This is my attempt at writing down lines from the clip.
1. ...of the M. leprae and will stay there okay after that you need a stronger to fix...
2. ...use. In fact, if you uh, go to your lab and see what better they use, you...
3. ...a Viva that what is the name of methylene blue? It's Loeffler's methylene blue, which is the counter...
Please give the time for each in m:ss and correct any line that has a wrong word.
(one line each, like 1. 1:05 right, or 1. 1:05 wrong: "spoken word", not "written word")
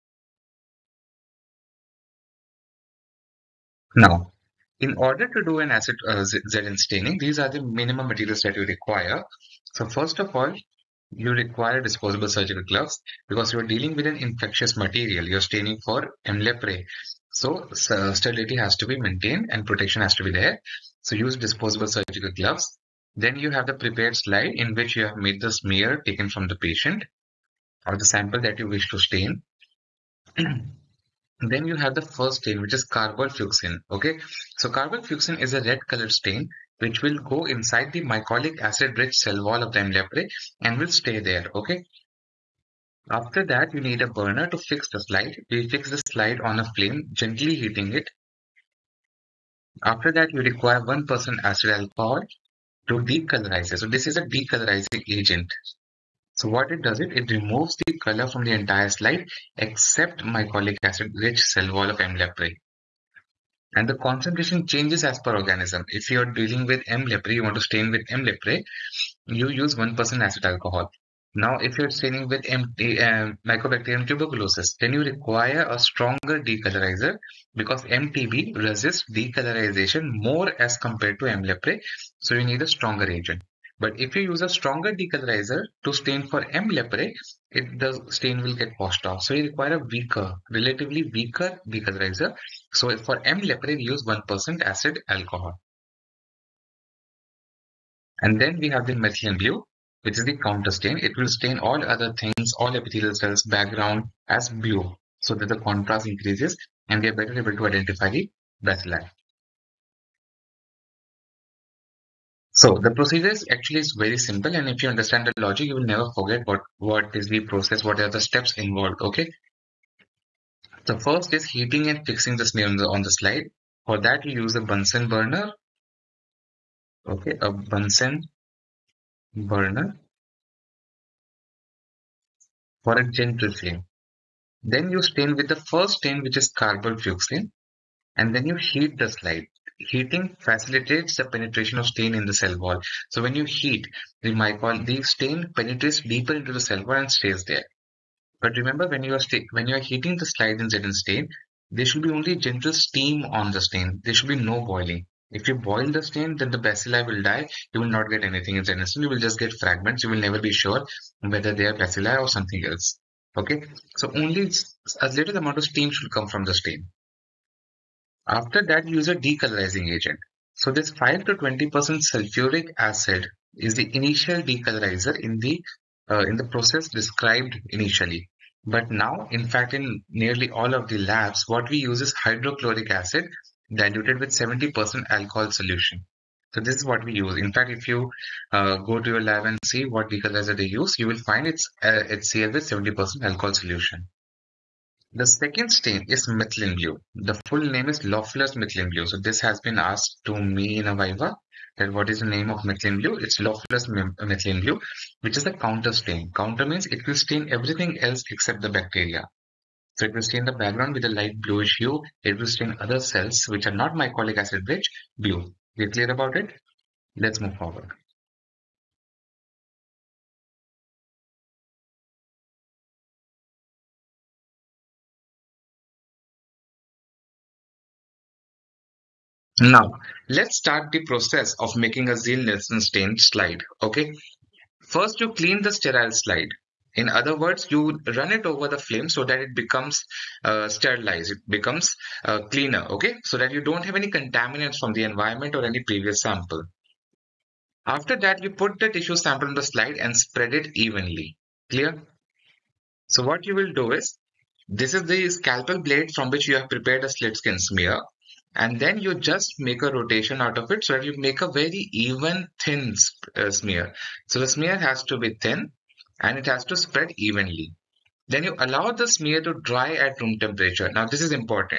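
1. 0:39 wrong: "burner", not "stronger"
2. 3:07 wrong: "decolorizer", not "better"
3. 3:20 right.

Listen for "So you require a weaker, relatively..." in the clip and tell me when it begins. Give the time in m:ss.
1:29.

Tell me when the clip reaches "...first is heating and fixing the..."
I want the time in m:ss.
2:01.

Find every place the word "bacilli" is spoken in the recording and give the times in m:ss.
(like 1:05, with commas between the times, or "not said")
1:48, 2:36, 2:41.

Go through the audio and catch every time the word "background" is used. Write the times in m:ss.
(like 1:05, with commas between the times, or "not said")
1:43, 3:30.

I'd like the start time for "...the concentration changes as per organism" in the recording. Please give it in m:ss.
1:03.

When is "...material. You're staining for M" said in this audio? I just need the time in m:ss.
0:14.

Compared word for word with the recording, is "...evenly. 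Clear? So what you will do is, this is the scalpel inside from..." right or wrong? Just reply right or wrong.
wrong.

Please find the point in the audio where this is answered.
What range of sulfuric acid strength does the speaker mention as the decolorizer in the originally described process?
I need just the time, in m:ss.
2:50.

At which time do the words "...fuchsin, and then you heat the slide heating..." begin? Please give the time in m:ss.
2:16.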